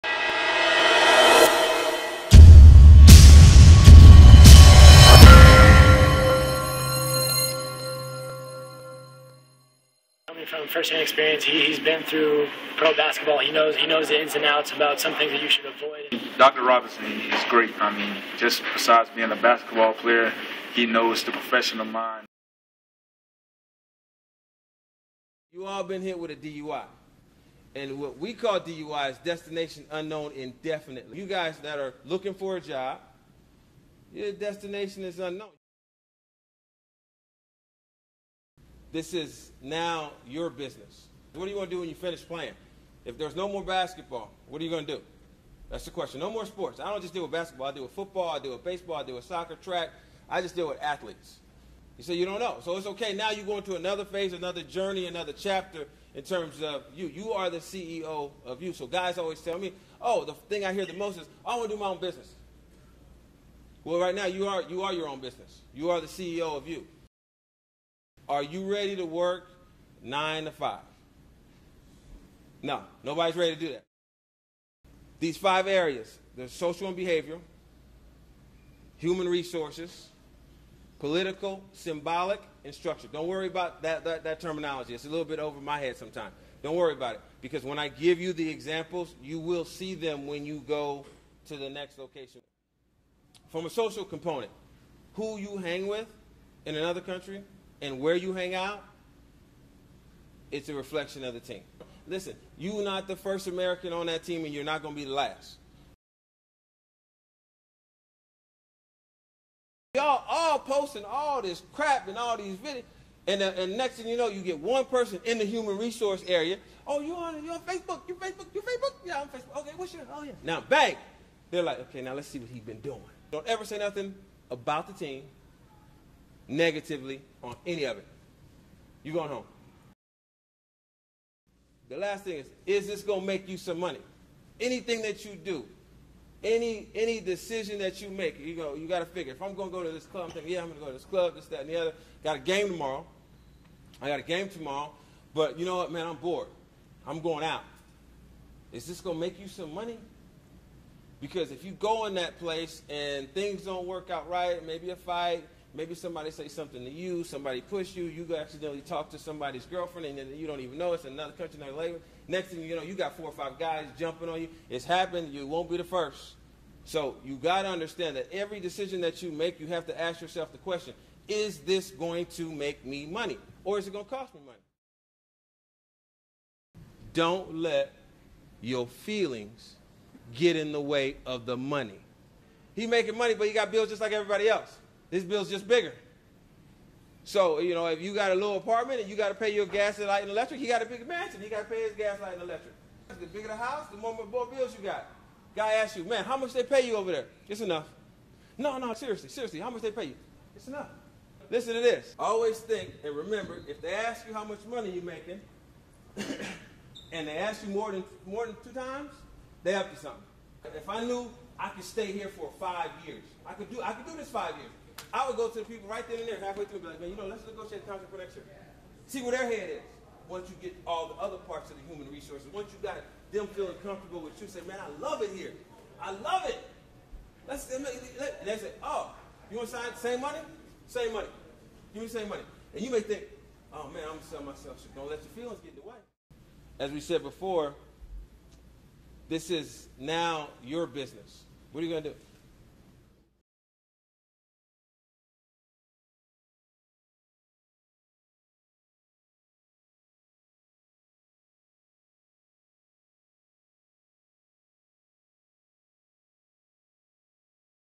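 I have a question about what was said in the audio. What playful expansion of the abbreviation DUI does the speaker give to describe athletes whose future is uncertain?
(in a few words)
Destination unknown indefinitely.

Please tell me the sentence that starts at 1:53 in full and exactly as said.
And, uh, and next thing you know, you get one person in the human resource area.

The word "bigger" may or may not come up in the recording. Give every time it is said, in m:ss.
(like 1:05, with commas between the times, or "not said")
3:05, 3:13.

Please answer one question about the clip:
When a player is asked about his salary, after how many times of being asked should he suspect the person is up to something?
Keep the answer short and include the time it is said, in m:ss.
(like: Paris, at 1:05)
2, at 3:28.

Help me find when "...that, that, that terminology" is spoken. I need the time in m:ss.
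1:23.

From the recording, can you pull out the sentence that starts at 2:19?
If I'm gonna go to this club, I'm thinking, yeah, I'm gonna go to this club, this, that, and the other.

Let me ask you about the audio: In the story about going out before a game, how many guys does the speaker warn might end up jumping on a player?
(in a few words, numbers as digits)
4 or 5.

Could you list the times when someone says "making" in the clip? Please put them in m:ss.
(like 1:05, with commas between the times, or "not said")
3:02, 3:25.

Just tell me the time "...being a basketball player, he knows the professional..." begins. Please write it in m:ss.
0:19.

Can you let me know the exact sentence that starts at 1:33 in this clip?
From a social component, who you hang with in another country, and where you hang out, it's a reflection of the team.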